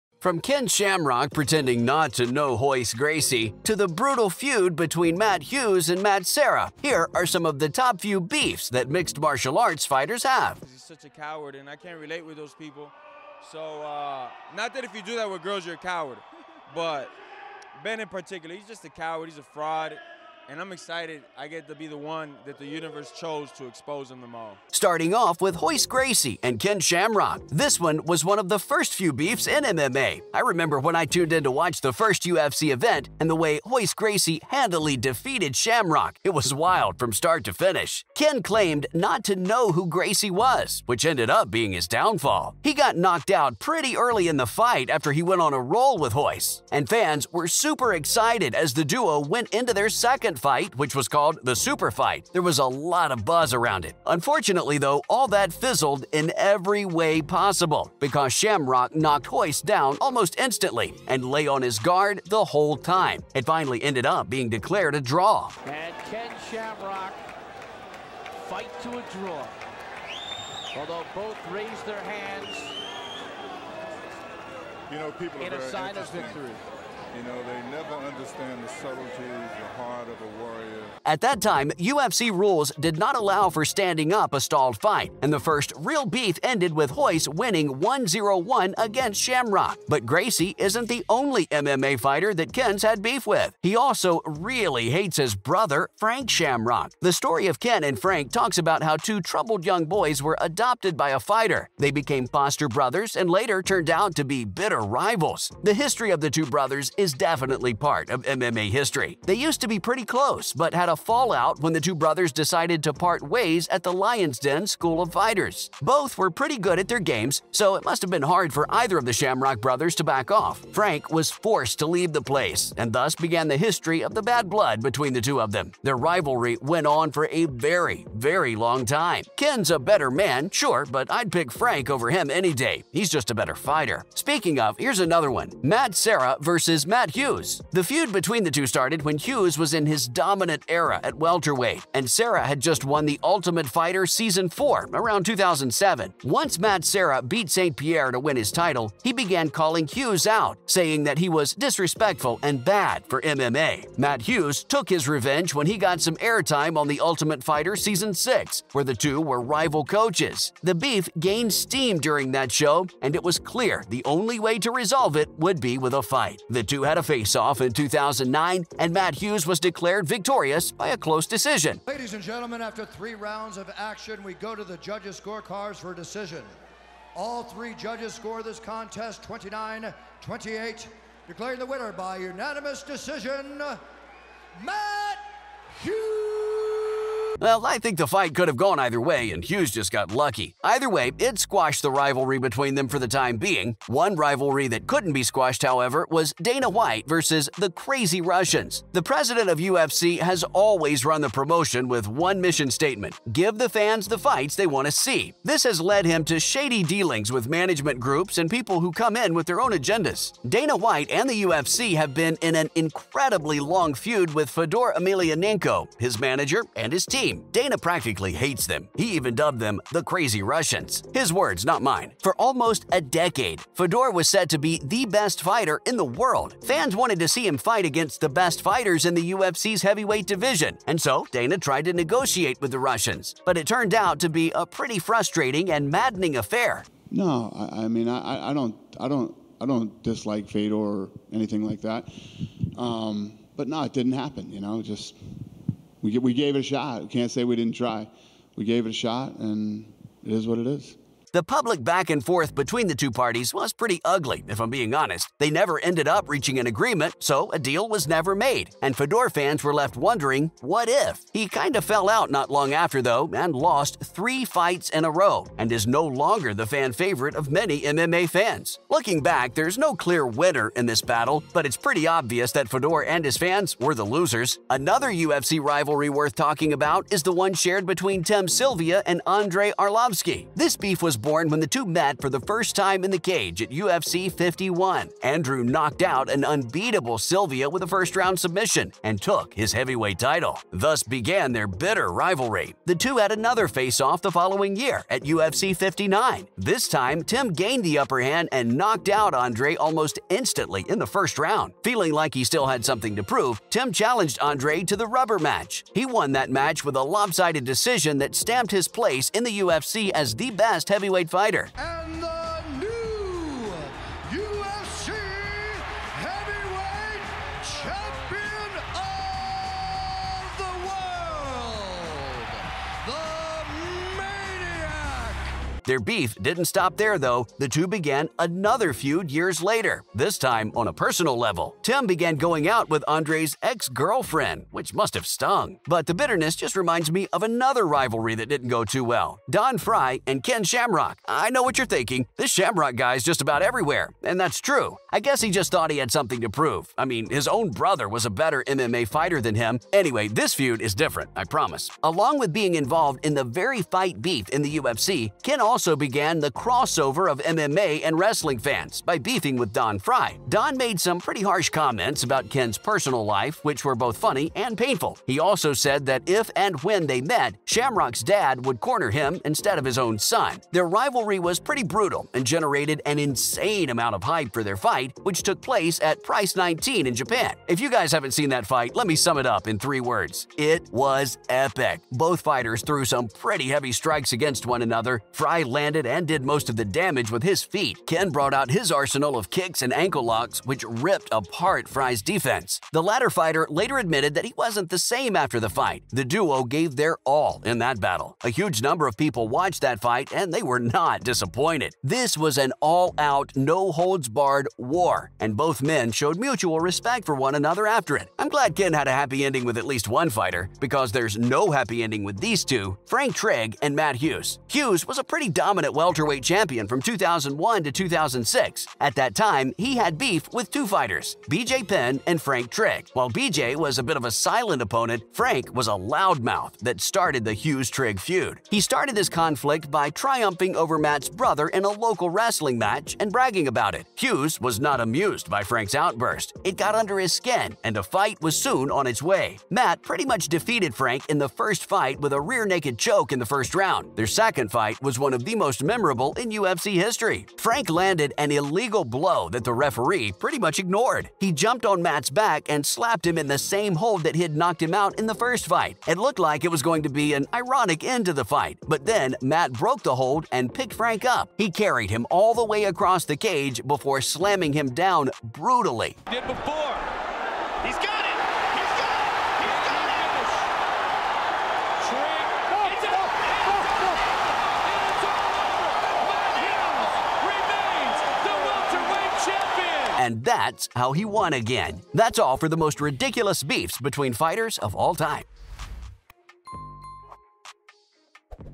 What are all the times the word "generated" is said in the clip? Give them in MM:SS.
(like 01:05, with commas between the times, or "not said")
06:12.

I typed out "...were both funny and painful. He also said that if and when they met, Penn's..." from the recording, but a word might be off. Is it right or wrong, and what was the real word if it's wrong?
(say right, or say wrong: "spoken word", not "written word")
wrong: "Shamrock", not "Penn".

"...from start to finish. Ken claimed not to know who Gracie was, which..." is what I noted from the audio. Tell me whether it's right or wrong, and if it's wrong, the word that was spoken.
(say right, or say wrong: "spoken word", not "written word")
right.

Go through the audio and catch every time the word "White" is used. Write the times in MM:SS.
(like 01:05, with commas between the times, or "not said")
03:16, 03:30.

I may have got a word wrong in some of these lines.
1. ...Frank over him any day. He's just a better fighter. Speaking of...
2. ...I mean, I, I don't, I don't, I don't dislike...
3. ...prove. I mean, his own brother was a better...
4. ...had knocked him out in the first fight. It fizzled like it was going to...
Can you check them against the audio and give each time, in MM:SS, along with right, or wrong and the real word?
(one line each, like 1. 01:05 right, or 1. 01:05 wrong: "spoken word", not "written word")
1. 02:11 right
2. 03:57 right
3. 05:46 right
4. 07:34 wrong: "looked", not "fizzled".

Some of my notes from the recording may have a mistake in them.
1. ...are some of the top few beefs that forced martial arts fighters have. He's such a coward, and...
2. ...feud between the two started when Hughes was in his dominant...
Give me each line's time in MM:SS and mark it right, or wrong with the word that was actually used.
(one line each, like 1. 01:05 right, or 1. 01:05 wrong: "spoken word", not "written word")
1. 00:07 wrong: "mixed", not "forced"
2. 02:17 right.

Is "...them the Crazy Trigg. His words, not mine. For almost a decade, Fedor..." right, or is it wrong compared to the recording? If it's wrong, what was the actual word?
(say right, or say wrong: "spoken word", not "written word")
wrong: "Russians", not "Trigg".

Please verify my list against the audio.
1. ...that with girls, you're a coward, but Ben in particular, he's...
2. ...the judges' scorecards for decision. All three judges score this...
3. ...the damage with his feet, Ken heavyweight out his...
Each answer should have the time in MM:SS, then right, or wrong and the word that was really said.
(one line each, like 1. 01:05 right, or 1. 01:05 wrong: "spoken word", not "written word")
1. 00:15 right
2. 02:54 right
3. 06:26 wrong: "brought", not "heavyweight".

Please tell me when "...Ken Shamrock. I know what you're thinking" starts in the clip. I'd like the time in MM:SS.
05:40.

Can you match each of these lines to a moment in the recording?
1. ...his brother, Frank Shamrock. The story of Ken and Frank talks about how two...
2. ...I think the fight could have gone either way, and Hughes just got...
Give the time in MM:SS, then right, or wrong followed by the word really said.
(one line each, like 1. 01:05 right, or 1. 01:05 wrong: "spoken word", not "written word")
1. 01:35 right
2. 03:07 right.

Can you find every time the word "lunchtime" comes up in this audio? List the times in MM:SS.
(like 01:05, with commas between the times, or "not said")
not said.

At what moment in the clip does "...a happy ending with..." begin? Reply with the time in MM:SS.
06:49.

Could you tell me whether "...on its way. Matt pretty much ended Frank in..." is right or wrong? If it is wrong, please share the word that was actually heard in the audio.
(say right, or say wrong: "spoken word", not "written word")
wrong: "defeated", not "ended".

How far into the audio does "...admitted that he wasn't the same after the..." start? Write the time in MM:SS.
06:33.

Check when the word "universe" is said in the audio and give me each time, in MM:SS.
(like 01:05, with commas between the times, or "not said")
00:22.